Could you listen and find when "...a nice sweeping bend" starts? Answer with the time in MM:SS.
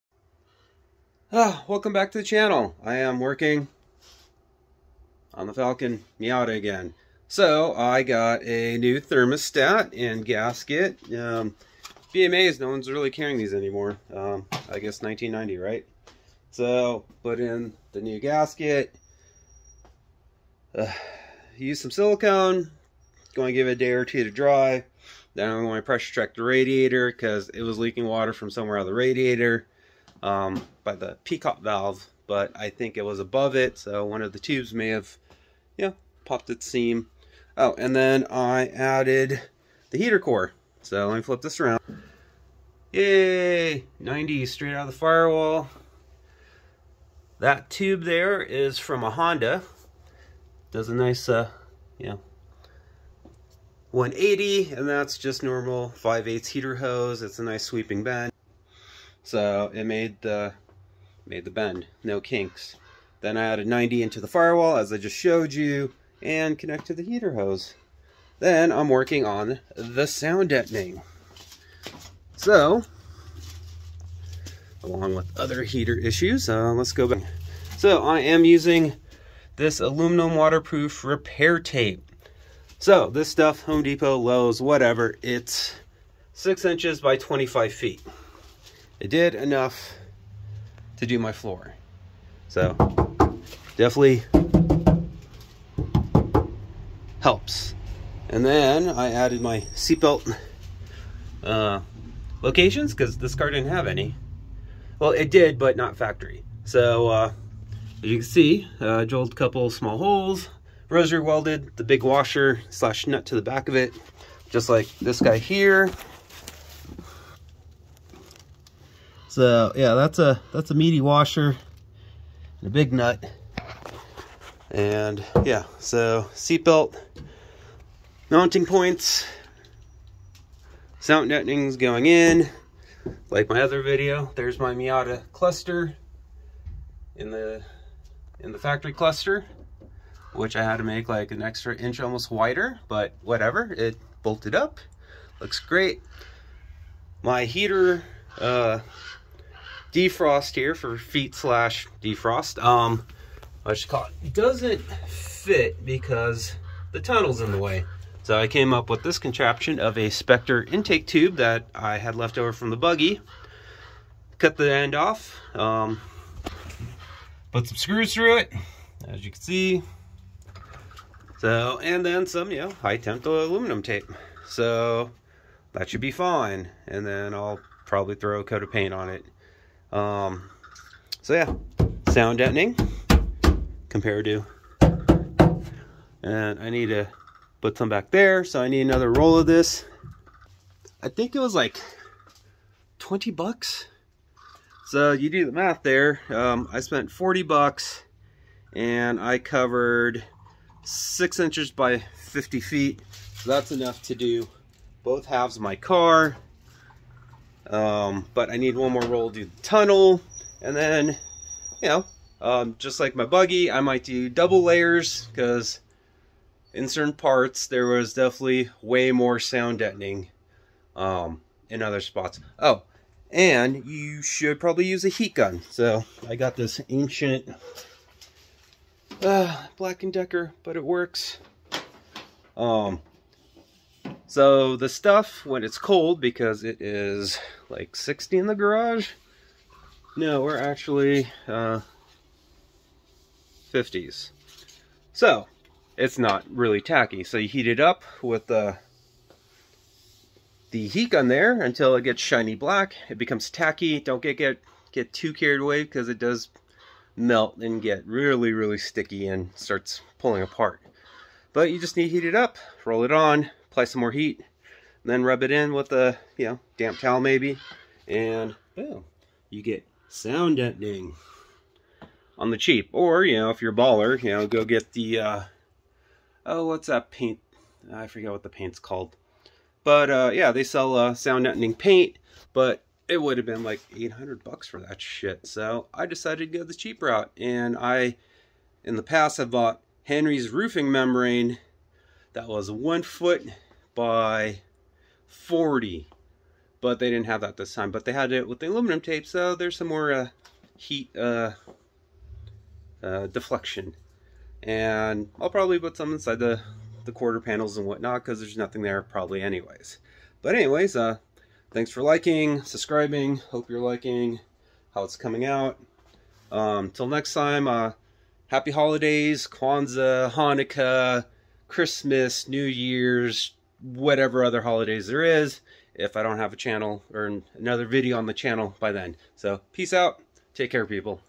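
00:57.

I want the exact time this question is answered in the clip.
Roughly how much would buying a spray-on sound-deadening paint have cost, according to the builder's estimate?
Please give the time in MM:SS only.
04:43.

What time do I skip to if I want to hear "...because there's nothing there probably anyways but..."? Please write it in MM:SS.
05:08.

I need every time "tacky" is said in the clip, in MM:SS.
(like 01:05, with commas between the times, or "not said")
04:06, 04:13.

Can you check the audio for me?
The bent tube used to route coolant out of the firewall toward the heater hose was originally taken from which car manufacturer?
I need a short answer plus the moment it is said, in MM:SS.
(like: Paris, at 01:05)
Honda, at 00:49.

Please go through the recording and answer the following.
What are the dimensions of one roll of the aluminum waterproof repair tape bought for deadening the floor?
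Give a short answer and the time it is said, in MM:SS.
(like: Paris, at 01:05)
6 inches by 25 feet, at 01:26.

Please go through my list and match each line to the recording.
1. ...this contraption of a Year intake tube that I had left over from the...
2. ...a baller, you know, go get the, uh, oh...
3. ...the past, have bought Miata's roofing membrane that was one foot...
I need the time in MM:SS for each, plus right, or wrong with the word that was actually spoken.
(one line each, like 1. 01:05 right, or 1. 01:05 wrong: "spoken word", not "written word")
1. 02:39 wrong: "Spectre", not "Year"
2. 04:33 right
3. 04:48 wrong: "Henry", not "Miata".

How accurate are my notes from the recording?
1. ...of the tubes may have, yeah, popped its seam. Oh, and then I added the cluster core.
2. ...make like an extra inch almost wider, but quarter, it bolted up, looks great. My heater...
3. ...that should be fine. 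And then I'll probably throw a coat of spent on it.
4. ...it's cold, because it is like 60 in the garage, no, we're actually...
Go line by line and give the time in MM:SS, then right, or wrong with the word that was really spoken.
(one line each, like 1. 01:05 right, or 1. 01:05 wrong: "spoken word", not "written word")
1. 00:34 wrong: "heater", not "cluster"
2. 02:20 wrong: "whatever", not "quarter"
3. 02:55 wrong: "paint", not "spent"
4. 03:55 right.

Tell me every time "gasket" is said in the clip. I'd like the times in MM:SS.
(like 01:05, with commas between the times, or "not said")
00:10, 00:18.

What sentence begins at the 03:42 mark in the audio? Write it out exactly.
Oh, and you should probably use a heat gun.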